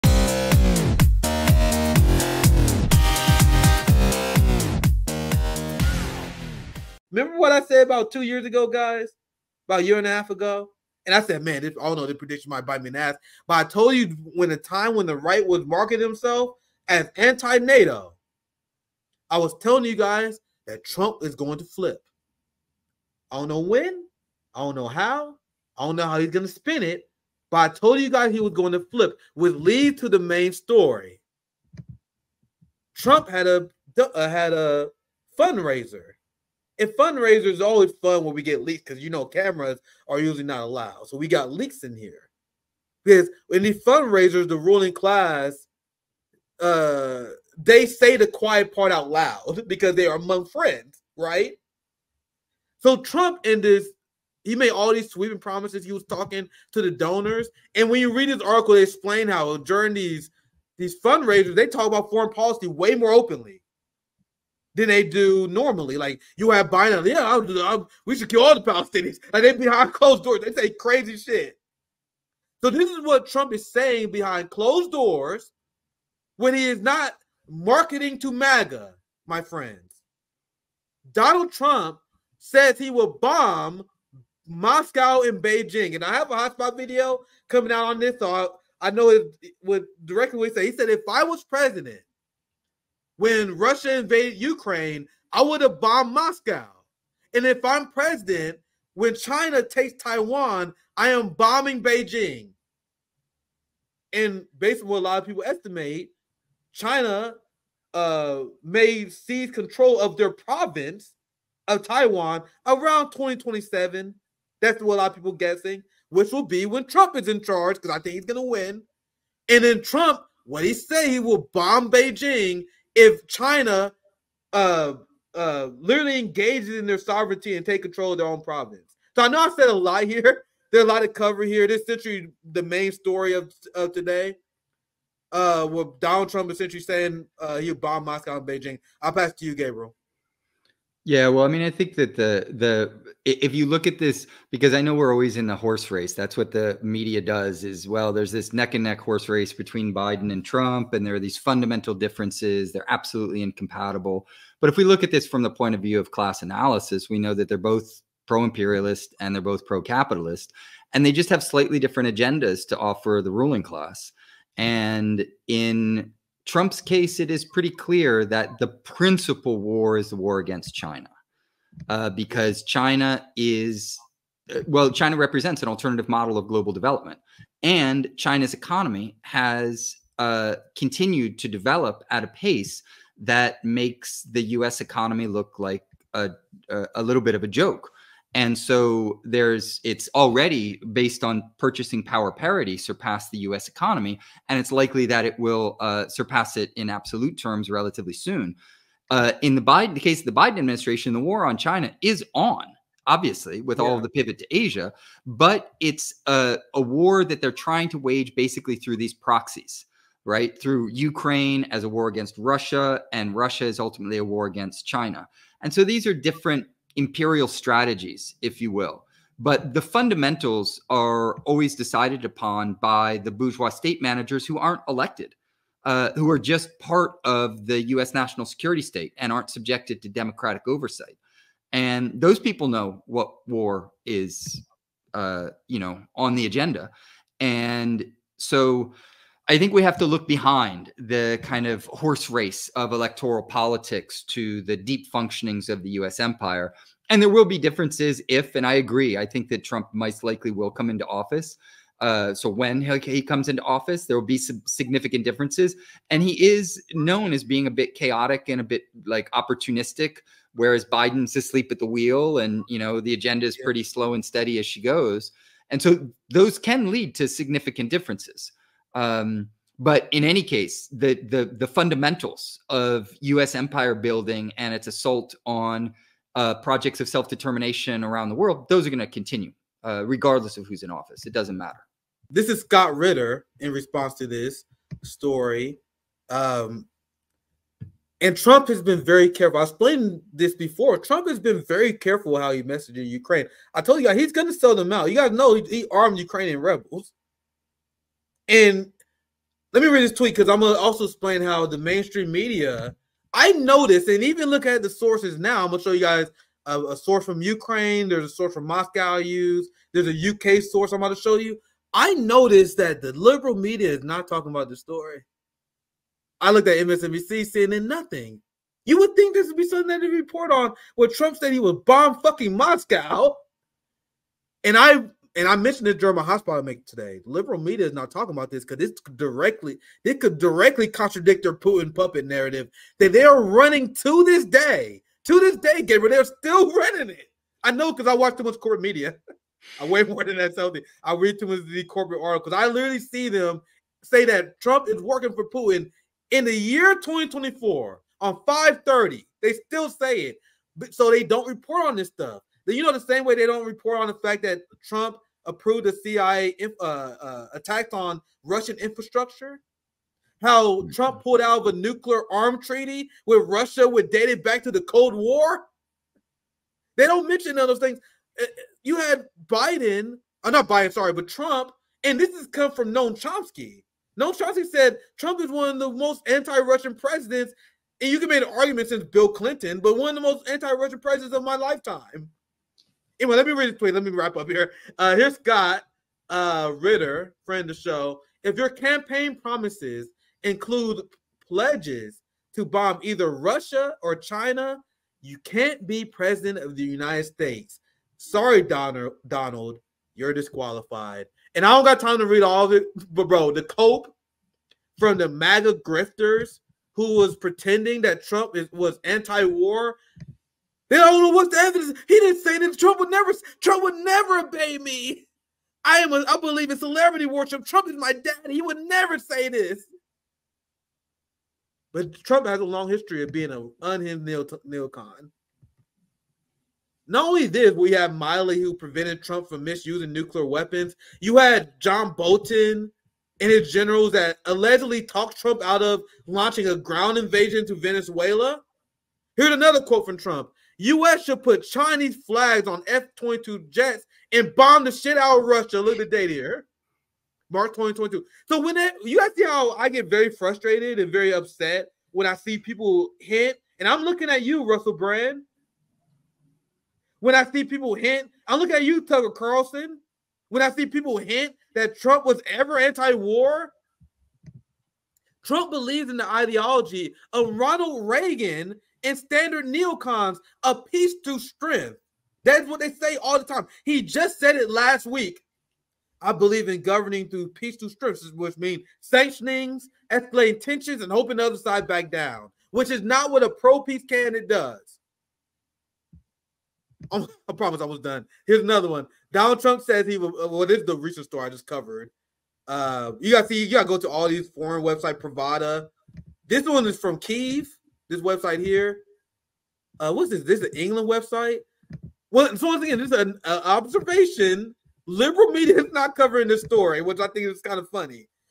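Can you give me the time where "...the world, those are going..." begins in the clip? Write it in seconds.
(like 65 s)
278 s.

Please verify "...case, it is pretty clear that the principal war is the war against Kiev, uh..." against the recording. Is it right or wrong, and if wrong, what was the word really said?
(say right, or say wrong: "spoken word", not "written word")
wrong: "China", not "Kiev".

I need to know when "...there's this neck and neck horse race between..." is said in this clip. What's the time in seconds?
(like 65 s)
148 s.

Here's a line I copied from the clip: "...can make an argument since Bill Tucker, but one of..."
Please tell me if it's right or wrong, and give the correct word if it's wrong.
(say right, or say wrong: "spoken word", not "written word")
wrong: "Clinton", not "Tucker".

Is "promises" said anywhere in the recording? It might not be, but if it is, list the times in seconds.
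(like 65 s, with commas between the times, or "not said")
55 s, 389 s, 487 s.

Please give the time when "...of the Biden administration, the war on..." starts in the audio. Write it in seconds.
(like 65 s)
200 s.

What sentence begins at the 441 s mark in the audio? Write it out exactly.
should put Chinese flags on F-22 jets and bomb the shit out of Russia.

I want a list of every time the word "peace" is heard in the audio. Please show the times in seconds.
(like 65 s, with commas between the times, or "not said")
470 s, 477 s, 483 s.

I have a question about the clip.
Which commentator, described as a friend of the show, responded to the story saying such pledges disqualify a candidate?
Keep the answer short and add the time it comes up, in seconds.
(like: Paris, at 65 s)
Scott Ritter, at 282 s.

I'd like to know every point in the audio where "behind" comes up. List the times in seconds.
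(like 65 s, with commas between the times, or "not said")
69 s, 74 s, 240 s.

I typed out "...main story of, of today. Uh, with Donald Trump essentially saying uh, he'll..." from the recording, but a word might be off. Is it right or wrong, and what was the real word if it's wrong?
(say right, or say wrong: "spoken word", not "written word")
right.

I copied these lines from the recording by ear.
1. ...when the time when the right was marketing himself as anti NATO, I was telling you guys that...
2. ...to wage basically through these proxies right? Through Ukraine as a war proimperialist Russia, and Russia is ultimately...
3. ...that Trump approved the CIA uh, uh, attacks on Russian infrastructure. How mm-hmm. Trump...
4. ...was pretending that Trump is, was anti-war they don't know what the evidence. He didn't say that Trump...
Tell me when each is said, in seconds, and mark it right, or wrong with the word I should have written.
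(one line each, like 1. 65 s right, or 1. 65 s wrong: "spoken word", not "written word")
1. 14 s right
2. 207 s wrong: "against", not "proimperialist"
3. 354 s right
4. 407 s right.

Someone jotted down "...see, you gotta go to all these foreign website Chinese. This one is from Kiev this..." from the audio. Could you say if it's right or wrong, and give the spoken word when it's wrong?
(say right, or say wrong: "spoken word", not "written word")
wrong: "Pravda", not "Chinese".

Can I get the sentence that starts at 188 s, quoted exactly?
And so there's it's already based on purchasing power parity surpassed the U.S.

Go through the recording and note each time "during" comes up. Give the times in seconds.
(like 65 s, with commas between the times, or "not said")
59 s, 325 s.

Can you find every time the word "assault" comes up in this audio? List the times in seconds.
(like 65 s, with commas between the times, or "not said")
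274 s.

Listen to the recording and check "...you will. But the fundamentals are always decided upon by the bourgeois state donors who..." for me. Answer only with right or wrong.
wrong.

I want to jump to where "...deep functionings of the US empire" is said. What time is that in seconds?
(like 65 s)
244 s.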